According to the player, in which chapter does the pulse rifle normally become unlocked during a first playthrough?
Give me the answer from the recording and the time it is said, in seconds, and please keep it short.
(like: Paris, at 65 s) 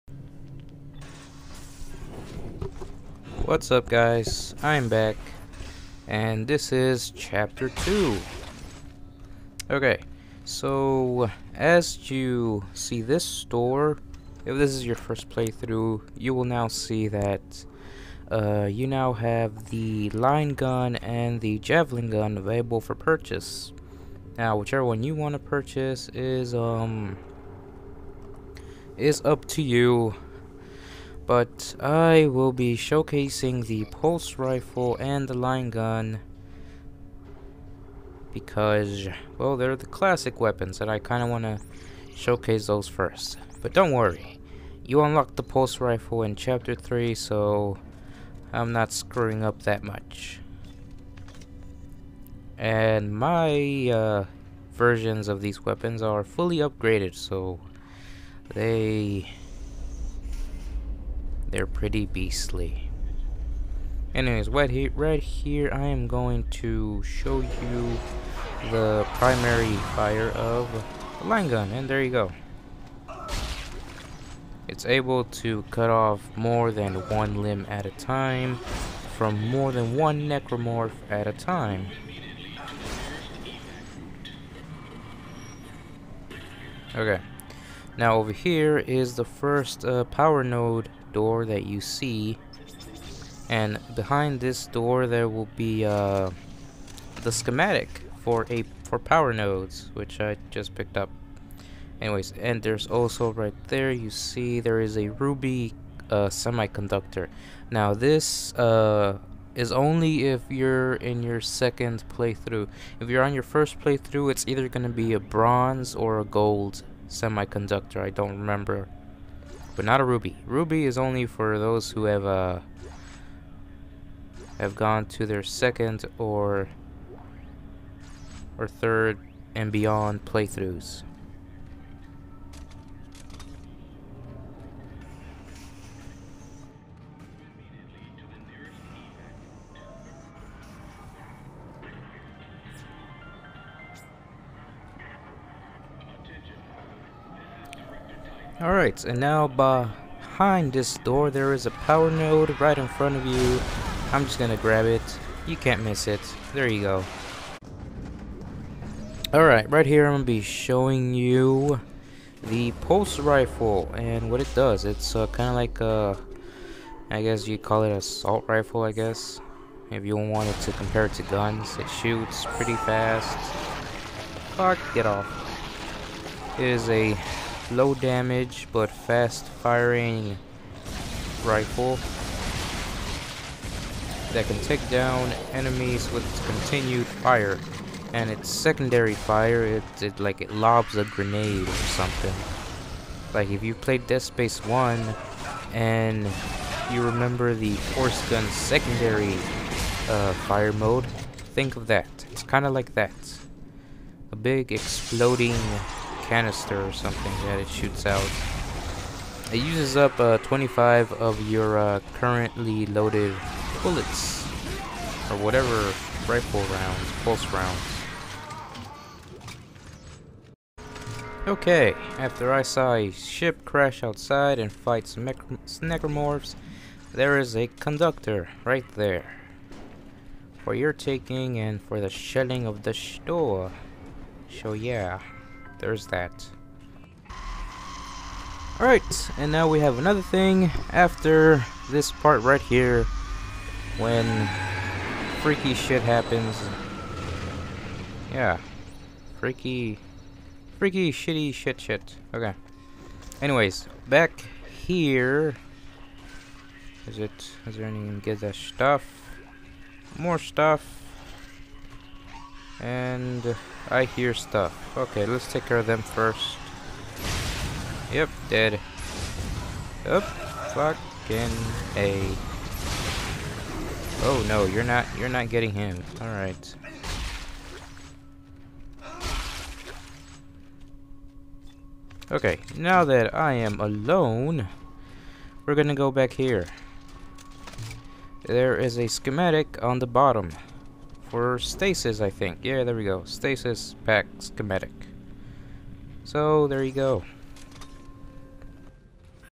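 Chapter 3, at 46 s.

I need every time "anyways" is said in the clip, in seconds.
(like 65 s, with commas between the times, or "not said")
64 s, 102 s, 253 s.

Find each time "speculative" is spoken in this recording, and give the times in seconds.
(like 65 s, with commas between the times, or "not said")
not said.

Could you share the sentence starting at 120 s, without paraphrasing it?
Ruby is only for those who have uh, have gone to their second or or third and beyond playthroughs.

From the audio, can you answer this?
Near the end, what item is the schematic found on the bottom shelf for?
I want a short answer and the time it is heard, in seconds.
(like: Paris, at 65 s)
Stasis pack, at 293 s.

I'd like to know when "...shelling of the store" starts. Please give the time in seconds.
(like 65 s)
232 s.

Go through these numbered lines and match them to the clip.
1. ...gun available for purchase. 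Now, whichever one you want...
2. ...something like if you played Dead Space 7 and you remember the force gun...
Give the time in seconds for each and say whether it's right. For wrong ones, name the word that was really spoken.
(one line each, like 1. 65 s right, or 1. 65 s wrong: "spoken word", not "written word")
1. 22 s right
2. 191 s wrong: "1", not "7".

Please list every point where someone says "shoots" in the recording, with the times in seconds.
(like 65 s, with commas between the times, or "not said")
171 s, 207 s.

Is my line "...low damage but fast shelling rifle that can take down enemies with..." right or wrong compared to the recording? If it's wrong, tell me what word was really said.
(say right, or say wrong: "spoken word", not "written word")
wrong: "firing", not "shelling".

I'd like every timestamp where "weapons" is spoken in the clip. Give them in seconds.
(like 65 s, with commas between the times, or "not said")
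40 s, 55 s.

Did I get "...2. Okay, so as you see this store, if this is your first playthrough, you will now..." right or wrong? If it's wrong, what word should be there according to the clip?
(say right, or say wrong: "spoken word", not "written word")
right.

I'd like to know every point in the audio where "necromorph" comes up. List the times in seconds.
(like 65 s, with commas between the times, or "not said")
80 s, 225 s.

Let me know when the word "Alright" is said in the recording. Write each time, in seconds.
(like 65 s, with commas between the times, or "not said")
148 s, 159 s, 238 s.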